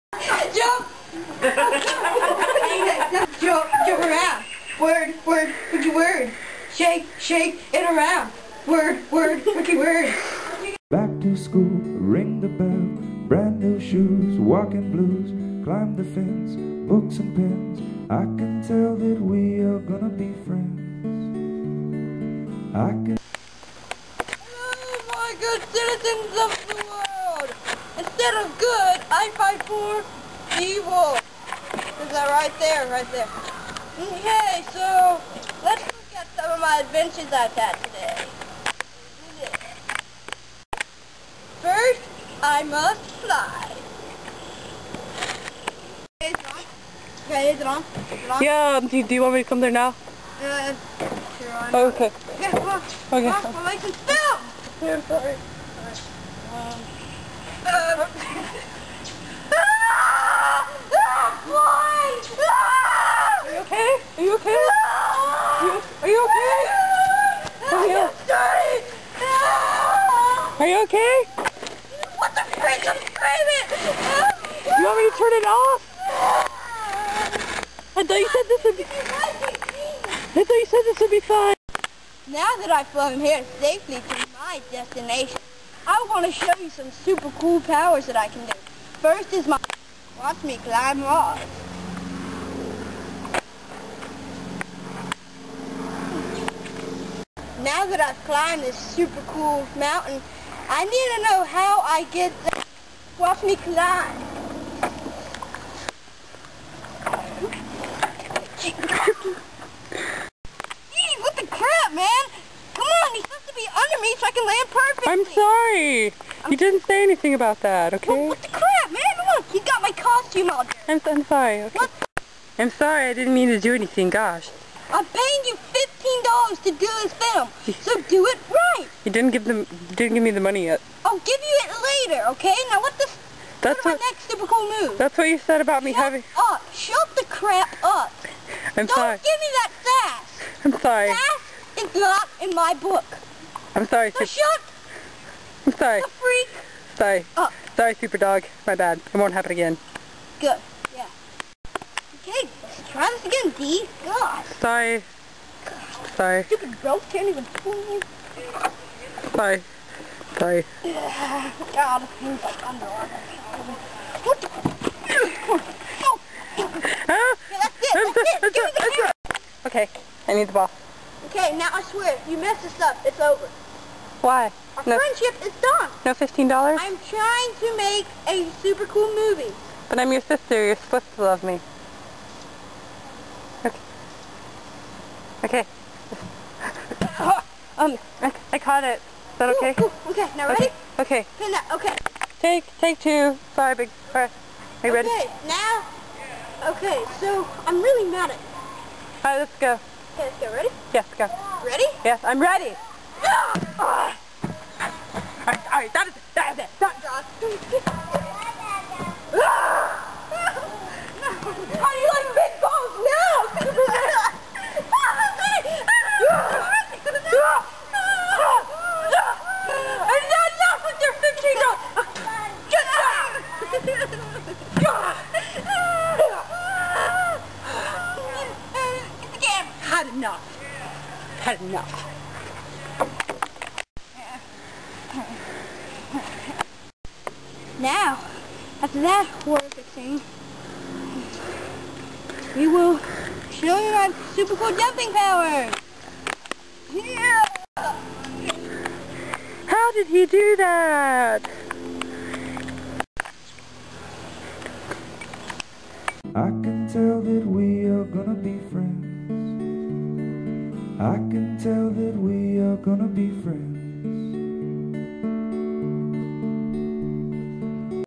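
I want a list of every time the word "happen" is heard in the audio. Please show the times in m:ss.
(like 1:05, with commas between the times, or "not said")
2:29.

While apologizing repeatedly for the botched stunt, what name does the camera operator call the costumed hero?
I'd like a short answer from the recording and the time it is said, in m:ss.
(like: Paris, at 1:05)
super dog, at 2:27.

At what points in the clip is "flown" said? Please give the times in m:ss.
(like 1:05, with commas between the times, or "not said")
1:22.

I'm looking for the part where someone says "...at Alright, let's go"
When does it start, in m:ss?
3:18.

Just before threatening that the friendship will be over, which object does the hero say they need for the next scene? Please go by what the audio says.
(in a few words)
the ball.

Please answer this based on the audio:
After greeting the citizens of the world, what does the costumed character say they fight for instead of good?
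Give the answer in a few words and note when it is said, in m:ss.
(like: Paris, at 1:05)
evil, at 0:30.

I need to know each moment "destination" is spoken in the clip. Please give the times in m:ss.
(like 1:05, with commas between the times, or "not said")
1:24.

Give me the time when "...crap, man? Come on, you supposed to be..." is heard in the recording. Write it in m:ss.
1:51.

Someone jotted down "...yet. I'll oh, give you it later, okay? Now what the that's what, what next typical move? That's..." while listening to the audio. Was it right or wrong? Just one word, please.
right.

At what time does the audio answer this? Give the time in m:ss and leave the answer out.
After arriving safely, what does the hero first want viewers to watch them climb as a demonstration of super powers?
1:31.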